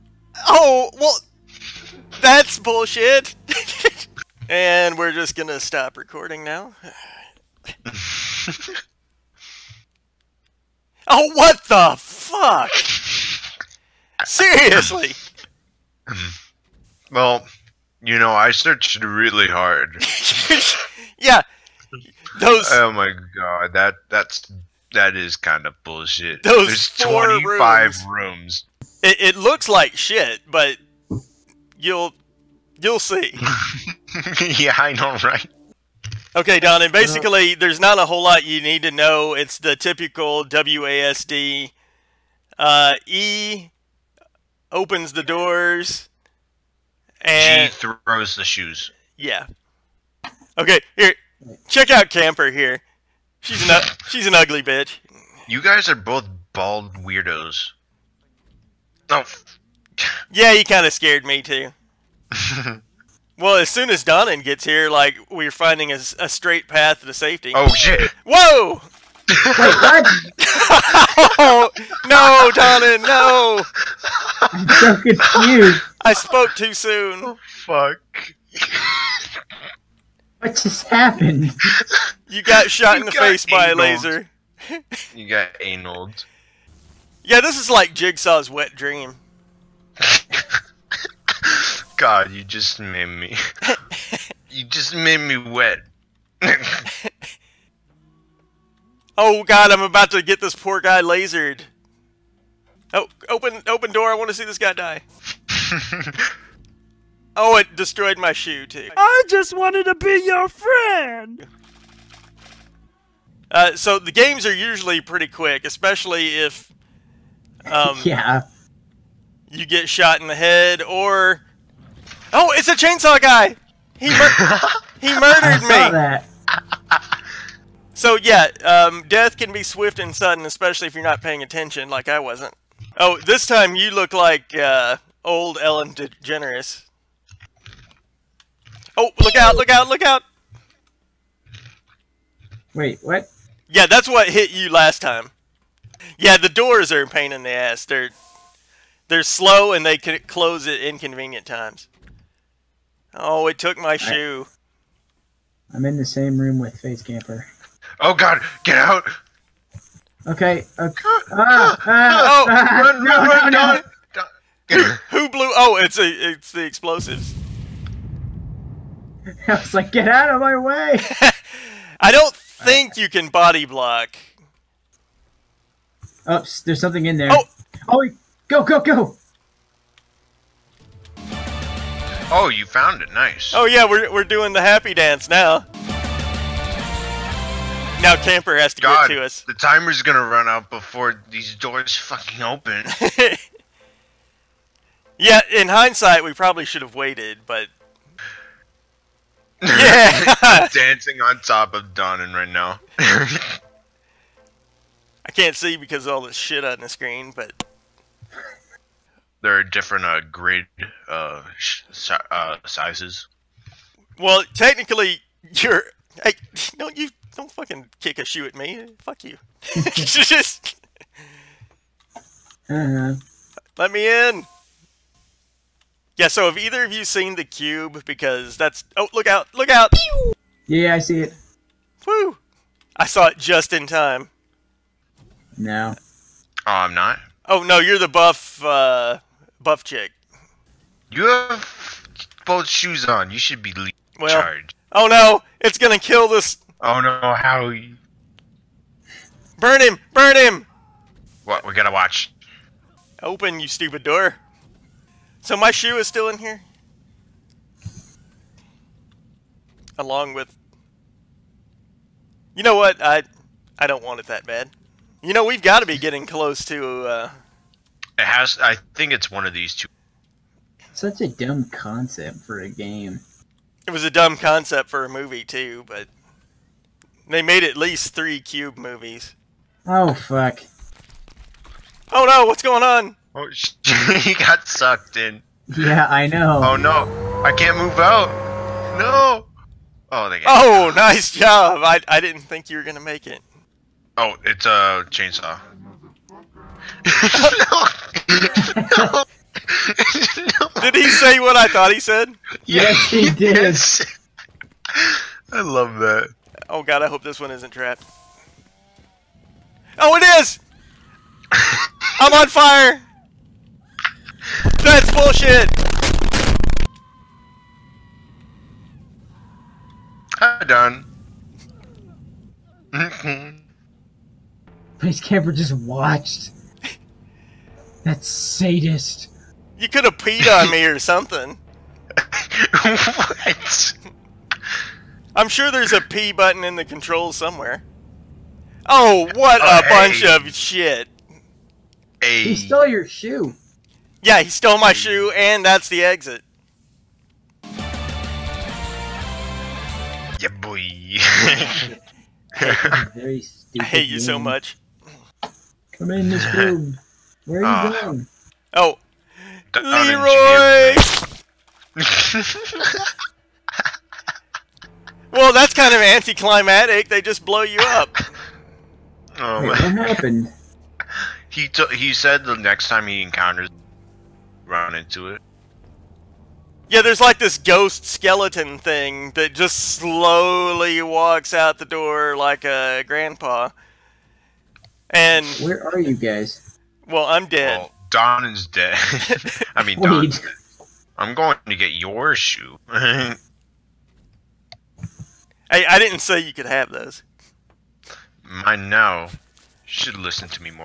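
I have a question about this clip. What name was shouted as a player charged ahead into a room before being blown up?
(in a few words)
Leroy.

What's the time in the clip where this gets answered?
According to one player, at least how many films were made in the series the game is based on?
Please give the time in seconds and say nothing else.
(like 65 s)
278 s.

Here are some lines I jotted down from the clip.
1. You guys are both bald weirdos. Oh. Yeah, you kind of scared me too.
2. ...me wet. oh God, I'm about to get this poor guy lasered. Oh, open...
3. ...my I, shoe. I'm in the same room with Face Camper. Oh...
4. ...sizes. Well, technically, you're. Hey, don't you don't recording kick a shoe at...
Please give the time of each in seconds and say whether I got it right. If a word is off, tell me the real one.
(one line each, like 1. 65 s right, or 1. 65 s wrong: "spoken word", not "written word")
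1. 55 s right
2. 95 s right
3. 153 s right
4. 212 s wrong: "fucking", not "recording".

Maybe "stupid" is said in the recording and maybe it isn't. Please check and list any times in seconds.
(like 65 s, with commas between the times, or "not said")
253 s, 353 s.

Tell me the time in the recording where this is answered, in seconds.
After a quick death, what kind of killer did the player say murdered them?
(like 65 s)
122 s.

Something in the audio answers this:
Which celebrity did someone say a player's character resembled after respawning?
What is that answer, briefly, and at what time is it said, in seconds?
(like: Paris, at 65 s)
Ellen DeGeneres, at 135 s.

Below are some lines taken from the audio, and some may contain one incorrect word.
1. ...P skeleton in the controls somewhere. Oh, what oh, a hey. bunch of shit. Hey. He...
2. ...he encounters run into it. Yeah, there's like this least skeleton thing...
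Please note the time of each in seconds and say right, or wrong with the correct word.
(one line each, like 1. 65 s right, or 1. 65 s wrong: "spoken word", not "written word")
1. 336 s wrong: "button", not "skeleton"
2. 373 s wrong: "ghost", not "least".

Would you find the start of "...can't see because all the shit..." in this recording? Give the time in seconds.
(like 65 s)
205 s.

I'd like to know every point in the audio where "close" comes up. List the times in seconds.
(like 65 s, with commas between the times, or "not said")
150 s, 266 s.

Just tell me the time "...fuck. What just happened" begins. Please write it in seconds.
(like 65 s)
77 s.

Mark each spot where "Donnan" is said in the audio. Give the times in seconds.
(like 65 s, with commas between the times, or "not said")
64 s, 72 s.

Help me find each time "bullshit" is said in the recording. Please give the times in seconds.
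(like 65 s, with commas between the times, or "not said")
2 s, 25 s, 315 s.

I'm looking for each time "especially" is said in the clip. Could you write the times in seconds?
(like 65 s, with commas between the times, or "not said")
115 s, 130 s.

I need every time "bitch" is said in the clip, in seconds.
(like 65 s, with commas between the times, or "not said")
54 s.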